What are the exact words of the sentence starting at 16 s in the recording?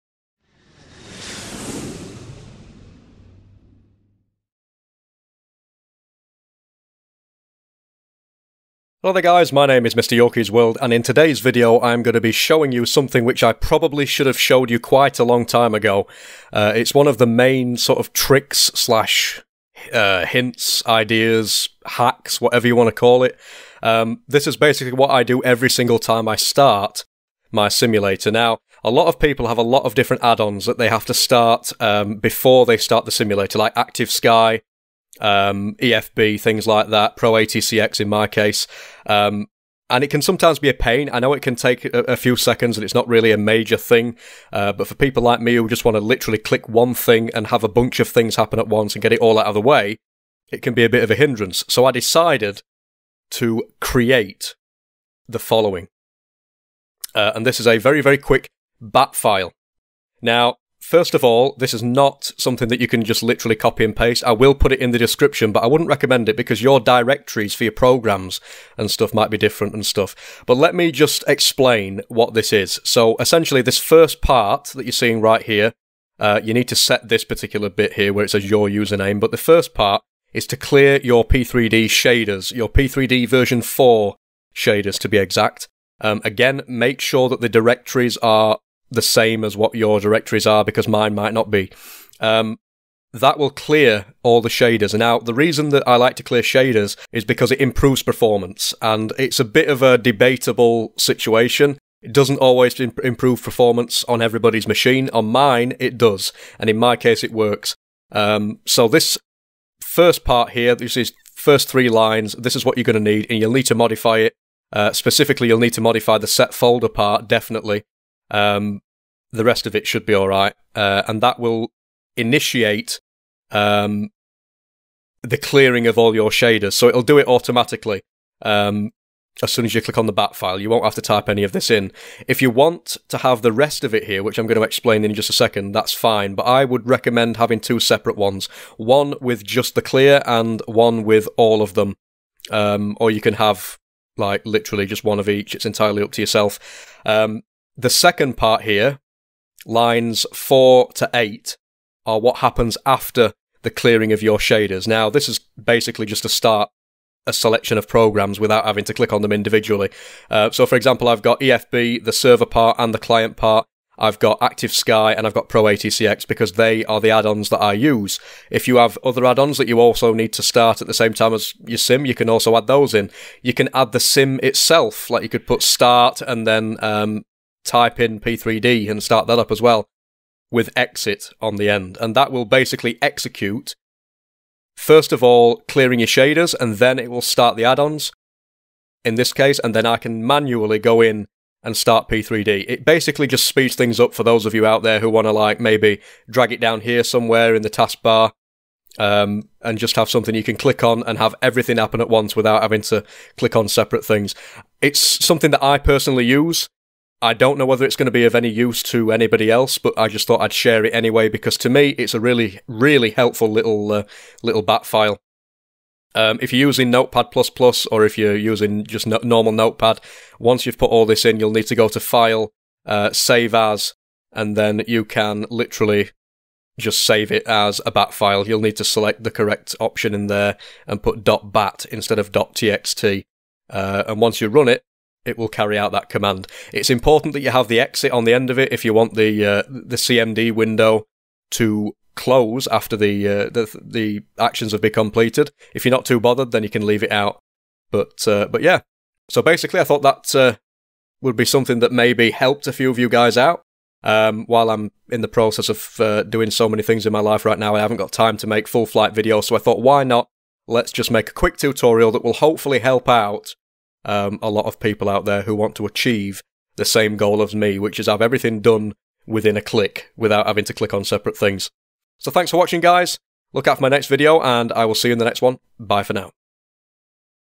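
Uh, it's one of the main sort of tricks slash uh, hints, ideas, hacks, whatever you want to call it.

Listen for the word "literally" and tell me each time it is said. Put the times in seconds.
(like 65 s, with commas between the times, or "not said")
46 s, 63 s, 144 s, 225 s.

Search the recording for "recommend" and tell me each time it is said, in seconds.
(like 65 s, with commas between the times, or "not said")
65 s, 136 s.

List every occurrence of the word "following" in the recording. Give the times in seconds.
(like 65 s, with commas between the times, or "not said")
55 s.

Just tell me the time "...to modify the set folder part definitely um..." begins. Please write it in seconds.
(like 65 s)
115 s.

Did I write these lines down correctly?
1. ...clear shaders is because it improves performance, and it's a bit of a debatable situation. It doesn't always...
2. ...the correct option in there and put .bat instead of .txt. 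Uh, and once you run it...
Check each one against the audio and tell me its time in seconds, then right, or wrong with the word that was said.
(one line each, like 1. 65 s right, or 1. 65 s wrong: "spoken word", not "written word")
1. 96 s right
2. 229 s right.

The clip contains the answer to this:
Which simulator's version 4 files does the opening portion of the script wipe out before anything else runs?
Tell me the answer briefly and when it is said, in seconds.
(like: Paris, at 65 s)
P3D, at 82 s.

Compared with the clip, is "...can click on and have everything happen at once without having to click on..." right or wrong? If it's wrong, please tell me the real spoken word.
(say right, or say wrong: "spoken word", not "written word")
right.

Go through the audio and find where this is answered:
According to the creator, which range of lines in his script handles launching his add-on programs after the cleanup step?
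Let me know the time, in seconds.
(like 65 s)
149 s.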